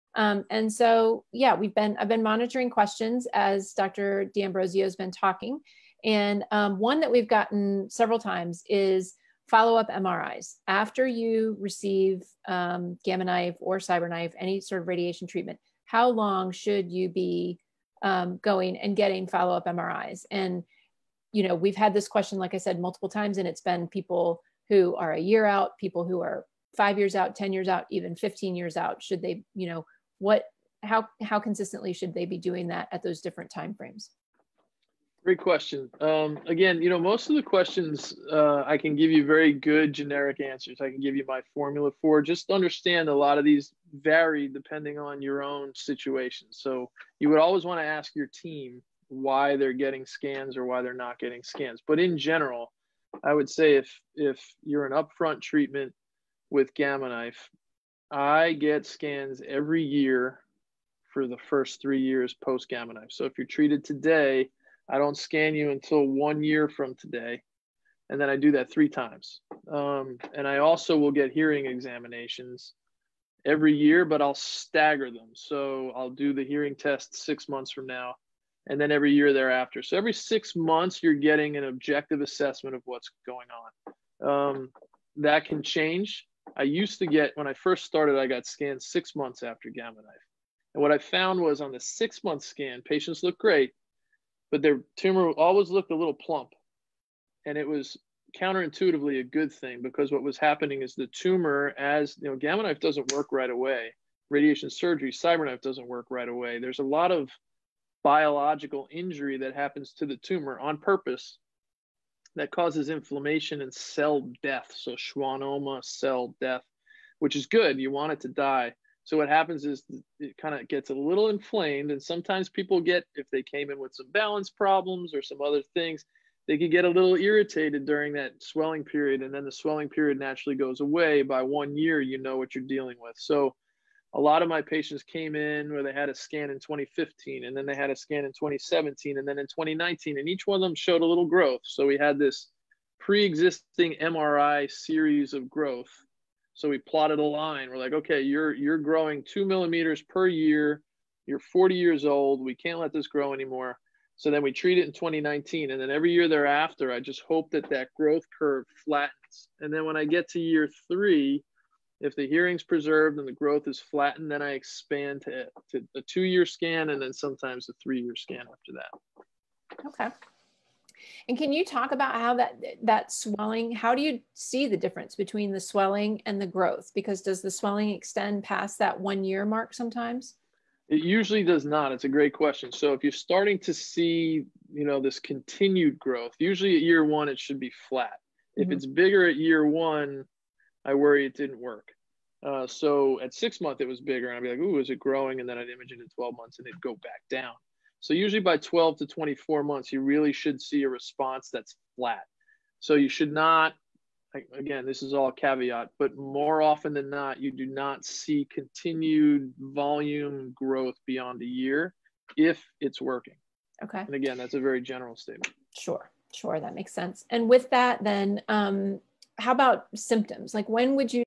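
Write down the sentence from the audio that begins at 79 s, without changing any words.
So every six months, you're getting an objective assessment of what's going on.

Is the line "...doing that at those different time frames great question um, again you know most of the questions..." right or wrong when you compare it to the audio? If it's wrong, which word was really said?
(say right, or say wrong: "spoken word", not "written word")
right.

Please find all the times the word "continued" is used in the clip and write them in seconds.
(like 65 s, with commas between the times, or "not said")
185 s, 208 s.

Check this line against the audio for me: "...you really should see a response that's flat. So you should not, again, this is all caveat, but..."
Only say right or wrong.
right.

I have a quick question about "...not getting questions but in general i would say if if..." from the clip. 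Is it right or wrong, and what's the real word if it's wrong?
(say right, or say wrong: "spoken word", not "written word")
wrong: "scans", not "questions".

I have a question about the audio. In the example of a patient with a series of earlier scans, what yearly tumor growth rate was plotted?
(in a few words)
2 millimeters per year.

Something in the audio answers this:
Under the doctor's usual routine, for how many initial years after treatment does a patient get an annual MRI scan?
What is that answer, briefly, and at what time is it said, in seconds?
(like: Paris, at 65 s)
3, at 61 s.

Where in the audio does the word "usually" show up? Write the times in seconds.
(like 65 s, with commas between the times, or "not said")
181 s, 186 s, 198 s.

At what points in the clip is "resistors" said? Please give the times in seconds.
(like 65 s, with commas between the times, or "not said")
not said.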